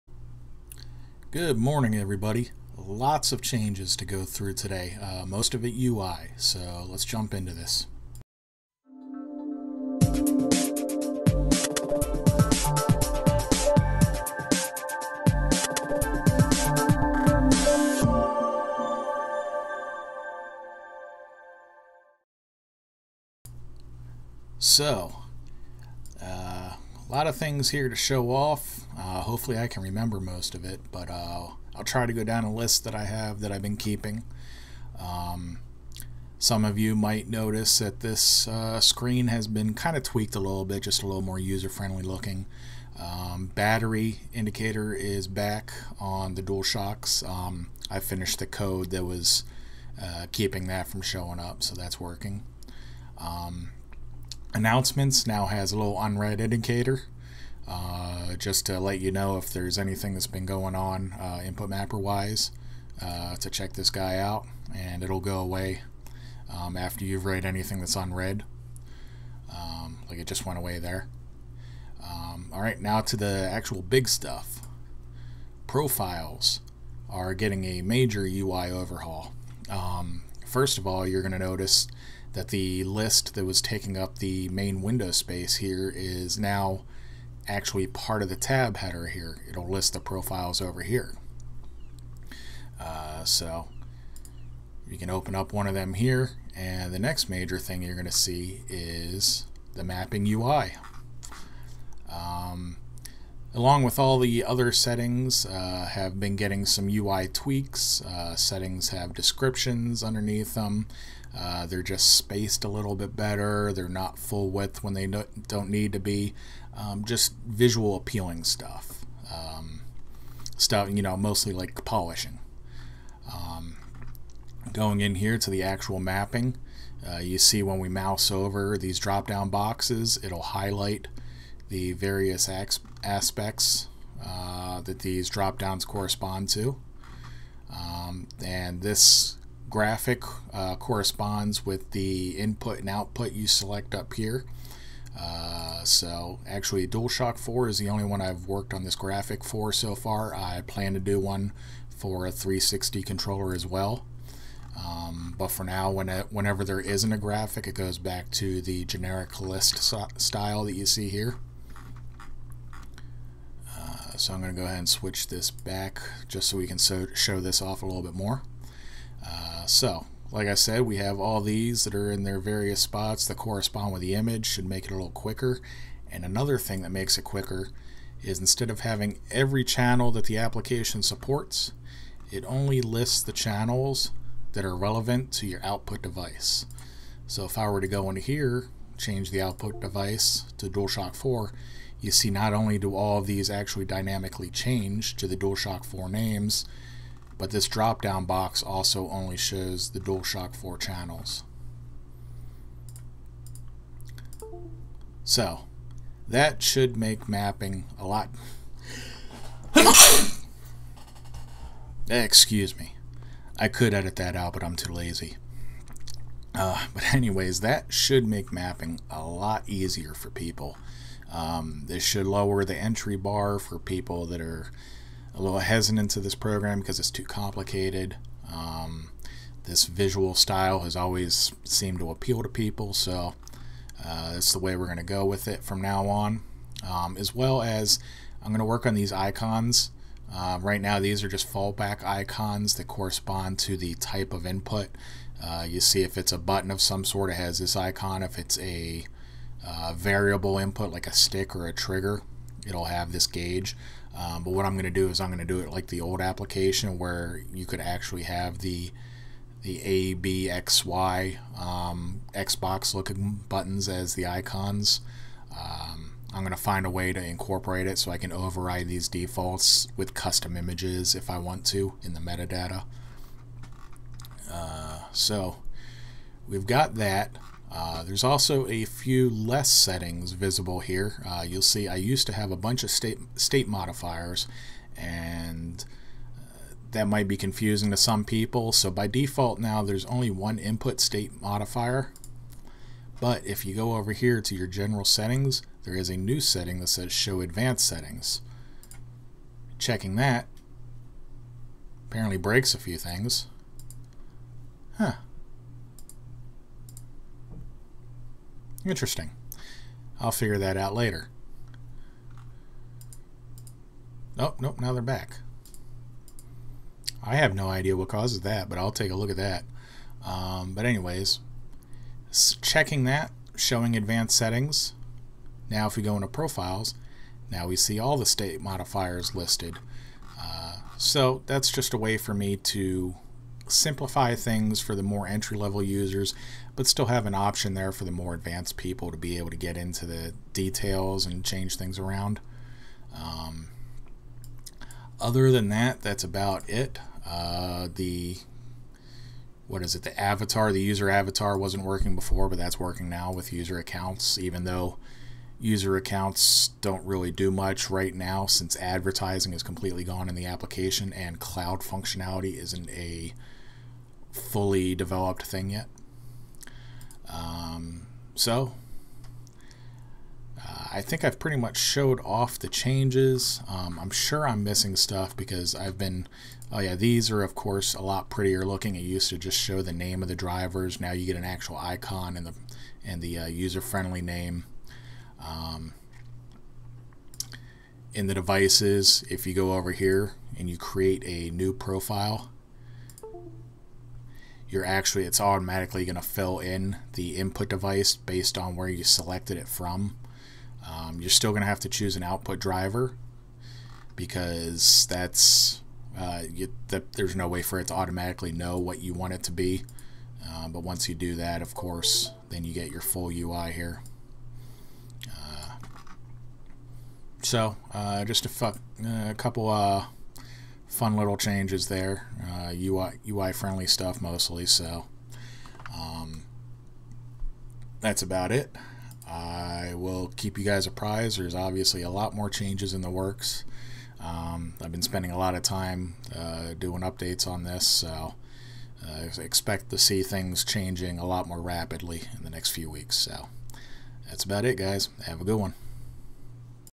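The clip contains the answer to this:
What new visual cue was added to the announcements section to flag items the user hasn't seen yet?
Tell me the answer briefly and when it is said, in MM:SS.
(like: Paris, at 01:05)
unread indicator, at 00:56.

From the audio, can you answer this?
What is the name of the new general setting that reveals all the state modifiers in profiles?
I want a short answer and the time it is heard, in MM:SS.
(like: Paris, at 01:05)
show advanced settings, at 04:57.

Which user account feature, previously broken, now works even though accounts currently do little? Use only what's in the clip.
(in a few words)
user avatar.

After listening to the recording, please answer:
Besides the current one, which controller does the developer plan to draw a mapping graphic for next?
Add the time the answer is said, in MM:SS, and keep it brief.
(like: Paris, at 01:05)
360 controller, at 02:32.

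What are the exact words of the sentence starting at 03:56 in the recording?
Um, as well as I'm going to work on these icons.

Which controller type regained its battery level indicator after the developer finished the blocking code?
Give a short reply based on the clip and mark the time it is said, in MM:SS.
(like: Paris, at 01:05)
DualShocks, at 00:46.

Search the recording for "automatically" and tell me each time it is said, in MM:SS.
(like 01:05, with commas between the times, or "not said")
06:35, 06:47.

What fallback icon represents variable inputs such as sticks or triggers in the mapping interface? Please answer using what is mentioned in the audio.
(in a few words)
gauge.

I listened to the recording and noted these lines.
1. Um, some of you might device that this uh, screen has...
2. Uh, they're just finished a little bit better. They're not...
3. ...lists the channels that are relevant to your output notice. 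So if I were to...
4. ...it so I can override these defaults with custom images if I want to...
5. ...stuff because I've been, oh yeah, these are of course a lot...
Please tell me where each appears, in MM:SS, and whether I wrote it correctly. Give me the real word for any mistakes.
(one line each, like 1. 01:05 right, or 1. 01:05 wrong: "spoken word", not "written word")
1. 00:34 wrong: "notice", not "device"
2. 01:51 wrong: "spaced", not "finished"
3. 03:02 wrong: "device", not "notice"
4. 04:27 right
5. 06:14 right.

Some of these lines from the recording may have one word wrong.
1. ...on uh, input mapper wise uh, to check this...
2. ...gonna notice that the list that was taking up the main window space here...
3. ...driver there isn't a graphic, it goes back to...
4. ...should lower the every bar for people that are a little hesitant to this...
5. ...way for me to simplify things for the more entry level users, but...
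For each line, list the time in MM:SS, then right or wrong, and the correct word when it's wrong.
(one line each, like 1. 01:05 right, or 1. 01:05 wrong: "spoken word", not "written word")
1. 01:00 right
2. 01:21 right
3. 02:36 wrong: "whenever", not "driver"
4. 03:42 wrong: "entry", not "every"
5. 05:31 right.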